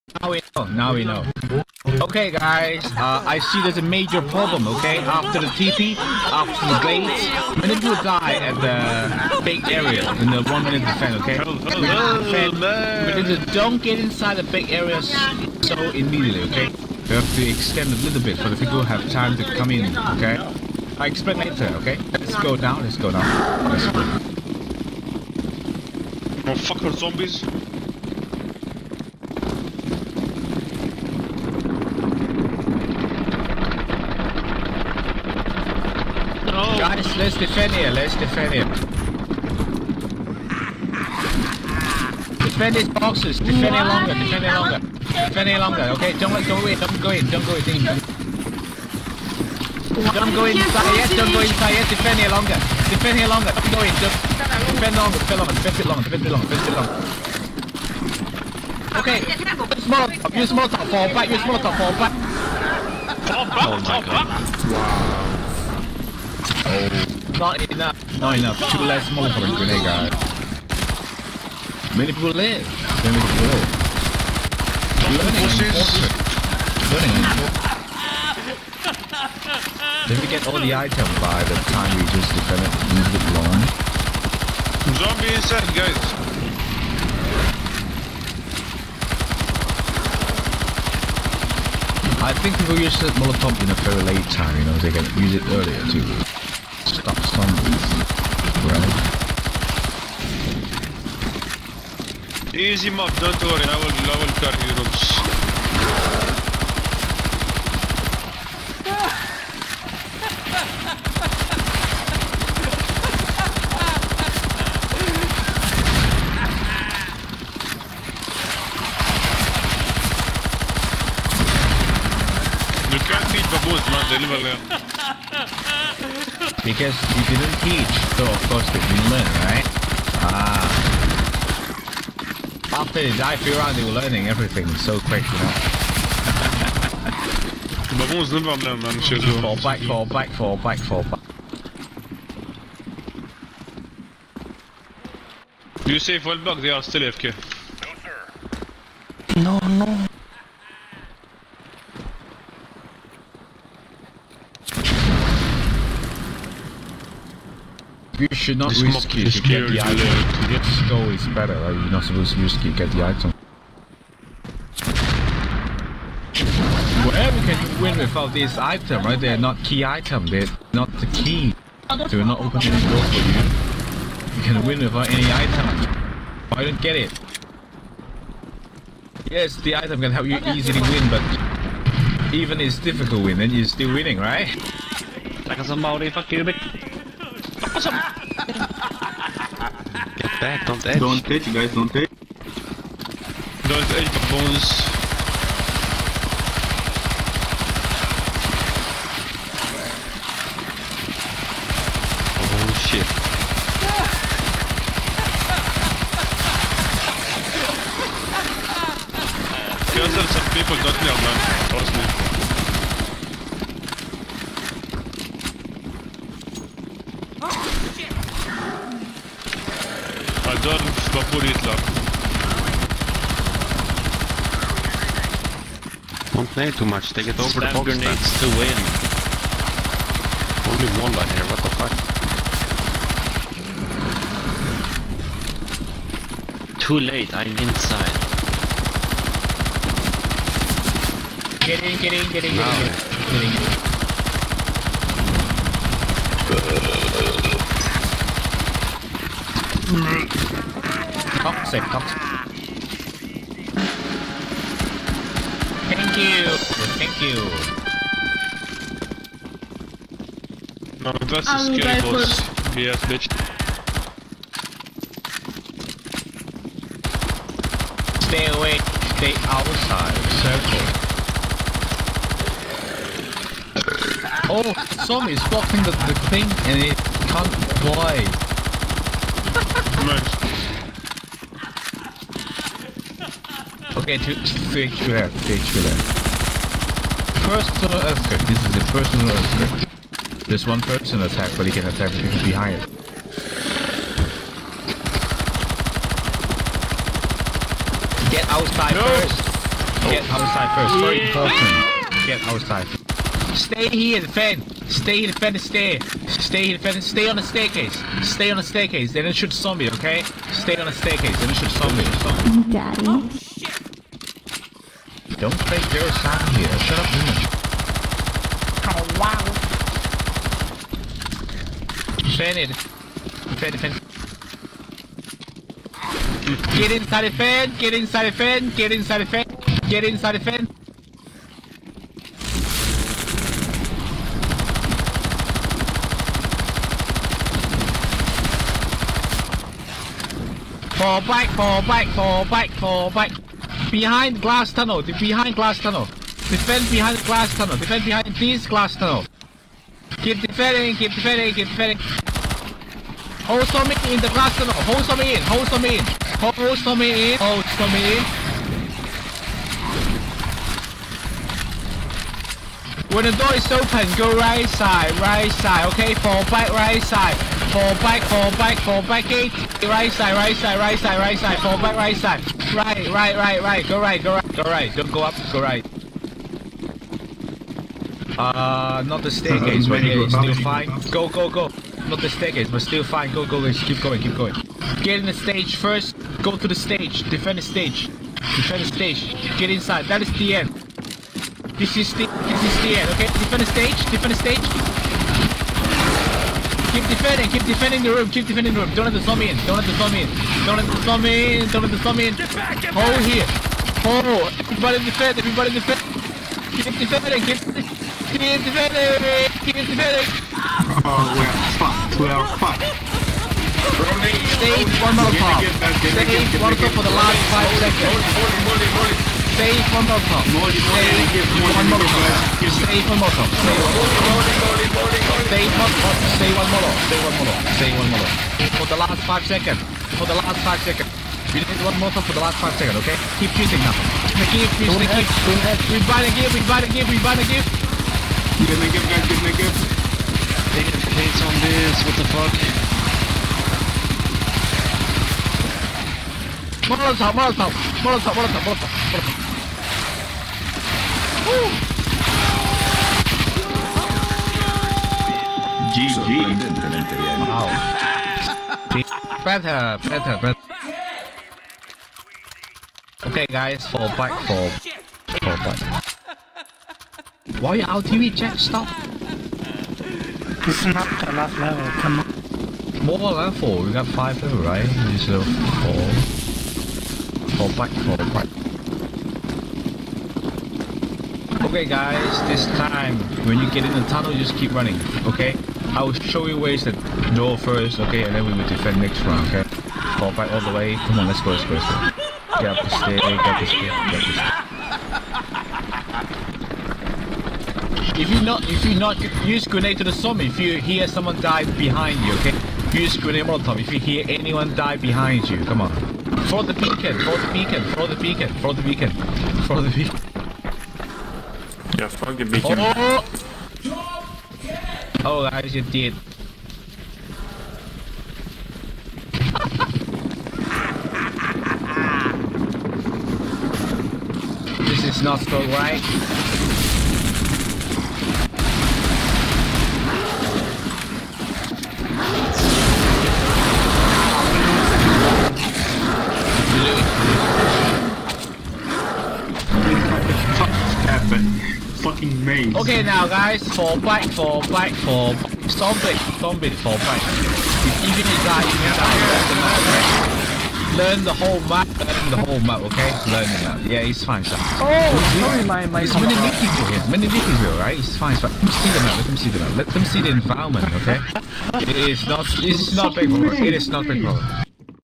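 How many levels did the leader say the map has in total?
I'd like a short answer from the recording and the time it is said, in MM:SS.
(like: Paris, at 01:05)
5, at 07:54.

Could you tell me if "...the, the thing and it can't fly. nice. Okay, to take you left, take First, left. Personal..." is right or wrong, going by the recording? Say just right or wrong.
right.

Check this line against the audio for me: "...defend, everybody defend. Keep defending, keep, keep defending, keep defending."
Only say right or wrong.
right.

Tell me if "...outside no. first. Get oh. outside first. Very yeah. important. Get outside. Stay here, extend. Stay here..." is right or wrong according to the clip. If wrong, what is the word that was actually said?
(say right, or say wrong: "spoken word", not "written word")
wrong: "defend", not "extend".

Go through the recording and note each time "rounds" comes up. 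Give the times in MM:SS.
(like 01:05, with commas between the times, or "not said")
02:13, 08:09.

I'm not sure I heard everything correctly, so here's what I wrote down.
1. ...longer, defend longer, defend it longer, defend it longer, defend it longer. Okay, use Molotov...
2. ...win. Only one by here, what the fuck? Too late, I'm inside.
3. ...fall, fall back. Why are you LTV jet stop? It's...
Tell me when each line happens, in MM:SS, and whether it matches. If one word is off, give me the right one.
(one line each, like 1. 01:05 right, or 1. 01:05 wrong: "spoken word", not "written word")
1. 00:54 right
2. 03:48 right
3. 07:44 right.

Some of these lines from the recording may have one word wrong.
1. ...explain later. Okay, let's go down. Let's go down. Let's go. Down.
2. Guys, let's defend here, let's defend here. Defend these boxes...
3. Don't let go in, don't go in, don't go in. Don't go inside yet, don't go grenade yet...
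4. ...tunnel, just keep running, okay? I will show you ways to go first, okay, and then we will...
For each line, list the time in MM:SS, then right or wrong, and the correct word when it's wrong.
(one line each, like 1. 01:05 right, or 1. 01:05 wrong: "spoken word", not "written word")
1. 00:21 right
2. 00:36 right
3. 00:46 wrong: "inside", not "grenade"
4. 08:04 right.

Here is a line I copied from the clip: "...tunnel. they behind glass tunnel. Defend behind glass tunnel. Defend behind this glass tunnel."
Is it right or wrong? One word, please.
right.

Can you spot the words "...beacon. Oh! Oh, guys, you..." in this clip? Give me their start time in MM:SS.
08:32.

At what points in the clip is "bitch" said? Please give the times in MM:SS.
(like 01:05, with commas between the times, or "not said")
03:06, 04:23.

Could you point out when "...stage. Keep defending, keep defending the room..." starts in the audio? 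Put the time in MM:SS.
06:34.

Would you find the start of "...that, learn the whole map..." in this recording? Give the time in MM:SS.
09:10.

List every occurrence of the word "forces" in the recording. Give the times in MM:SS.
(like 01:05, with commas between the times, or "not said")
01:15.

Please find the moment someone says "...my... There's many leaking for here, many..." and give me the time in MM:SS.
09:15.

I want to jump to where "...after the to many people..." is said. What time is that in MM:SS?
00:05.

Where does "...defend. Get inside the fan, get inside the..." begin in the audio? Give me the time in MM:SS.
05:23.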